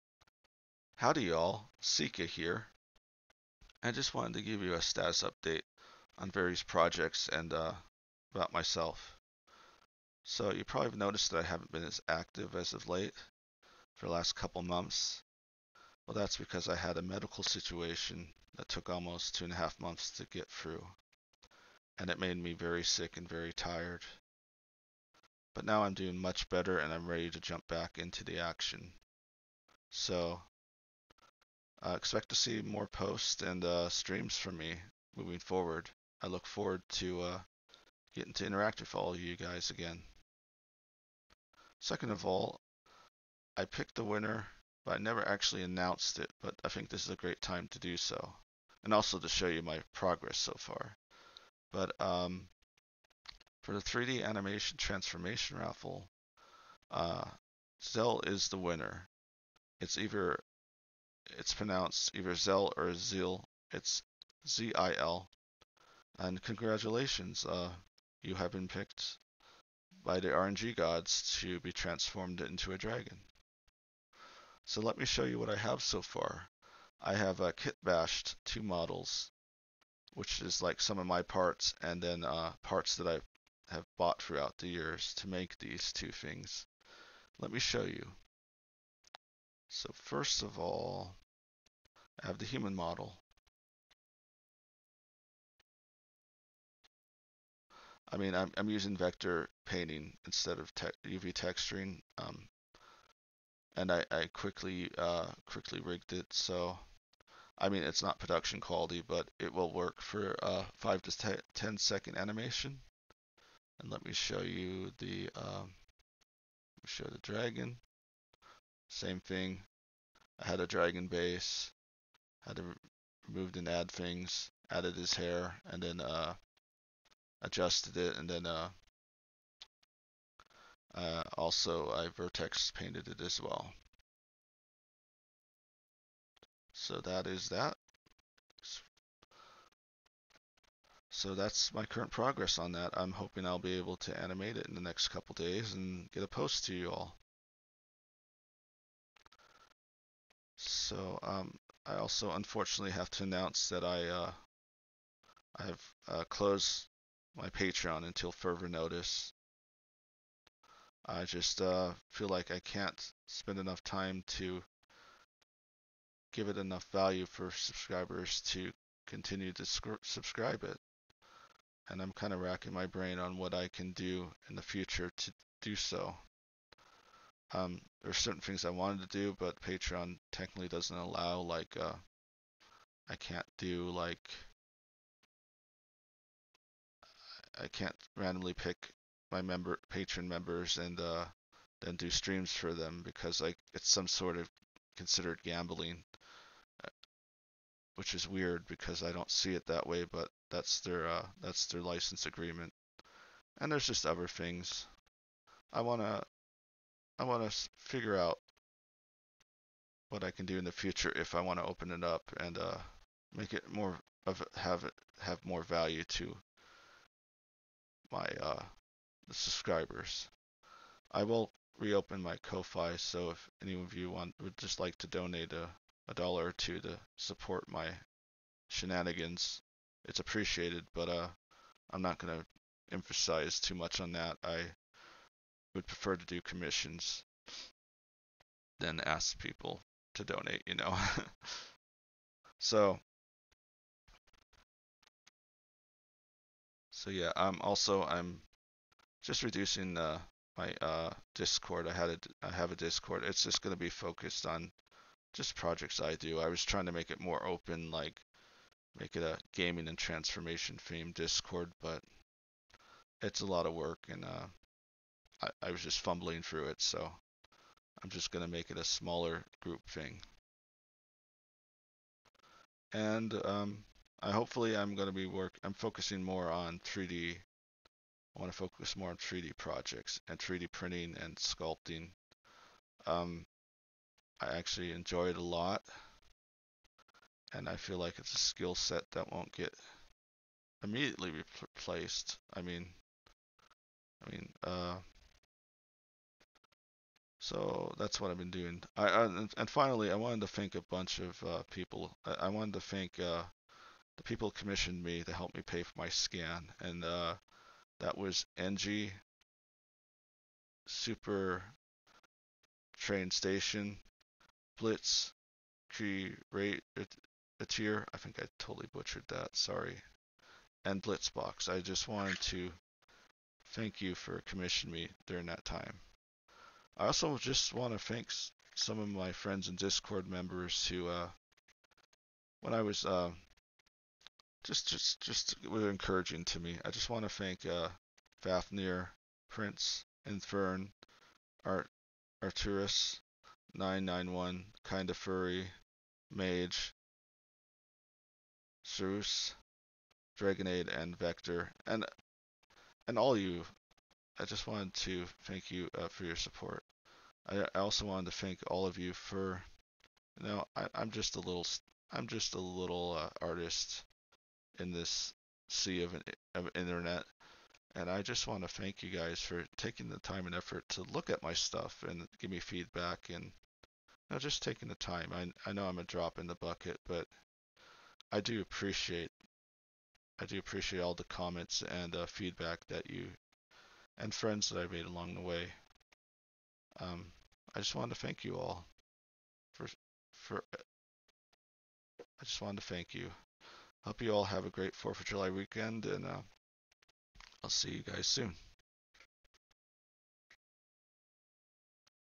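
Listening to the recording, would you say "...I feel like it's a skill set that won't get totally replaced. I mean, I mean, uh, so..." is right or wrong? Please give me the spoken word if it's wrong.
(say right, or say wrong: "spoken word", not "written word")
wrong: "immediately", not "totally".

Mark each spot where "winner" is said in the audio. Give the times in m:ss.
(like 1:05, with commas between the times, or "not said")
0:44, 0:58.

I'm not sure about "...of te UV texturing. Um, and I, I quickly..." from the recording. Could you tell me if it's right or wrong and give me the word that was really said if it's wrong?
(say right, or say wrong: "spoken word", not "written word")
right.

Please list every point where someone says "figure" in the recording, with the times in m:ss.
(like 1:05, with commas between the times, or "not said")
3:27.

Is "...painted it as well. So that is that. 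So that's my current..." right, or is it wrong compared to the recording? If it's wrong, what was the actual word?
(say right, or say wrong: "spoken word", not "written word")
right.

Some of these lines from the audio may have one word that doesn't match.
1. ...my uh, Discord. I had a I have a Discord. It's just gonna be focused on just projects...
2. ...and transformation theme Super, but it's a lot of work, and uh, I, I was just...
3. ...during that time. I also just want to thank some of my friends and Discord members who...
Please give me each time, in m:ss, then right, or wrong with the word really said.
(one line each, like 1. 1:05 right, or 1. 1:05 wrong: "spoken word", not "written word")
1. 4:10 right
2. 4:19 wrong: "Discord", not "Super"
3. 5:25 right.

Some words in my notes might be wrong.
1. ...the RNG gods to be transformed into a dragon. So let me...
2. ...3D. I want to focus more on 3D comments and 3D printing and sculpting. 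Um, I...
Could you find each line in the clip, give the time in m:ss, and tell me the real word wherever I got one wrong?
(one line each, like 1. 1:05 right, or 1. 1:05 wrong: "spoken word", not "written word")
1. 1:10 right
2. 4:36 wrong: "projects", not "comments".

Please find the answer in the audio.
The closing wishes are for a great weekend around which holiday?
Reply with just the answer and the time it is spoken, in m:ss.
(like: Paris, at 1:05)
Fourth of July, at 6:34.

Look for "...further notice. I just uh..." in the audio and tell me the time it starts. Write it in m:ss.
2:38.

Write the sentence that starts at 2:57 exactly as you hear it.
Um, there's certain things I wanted to do, but Patreon technically doesn't allow.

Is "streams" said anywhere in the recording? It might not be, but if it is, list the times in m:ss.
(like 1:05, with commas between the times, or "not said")
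0:33, 3:12.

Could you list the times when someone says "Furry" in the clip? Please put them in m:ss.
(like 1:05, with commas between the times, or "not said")
5:45.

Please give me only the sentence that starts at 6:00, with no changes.
You know, I, am just a little.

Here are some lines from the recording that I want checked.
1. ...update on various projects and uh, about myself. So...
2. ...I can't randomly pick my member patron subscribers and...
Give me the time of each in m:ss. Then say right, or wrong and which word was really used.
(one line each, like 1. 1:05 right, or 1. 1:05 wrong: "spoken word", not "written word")
1. 0:05 right
2. 3:07 wrong: "members", not "subscribers".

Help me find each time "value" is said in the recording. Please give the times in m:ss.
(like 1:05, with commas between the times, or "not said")
2:46, 3:35.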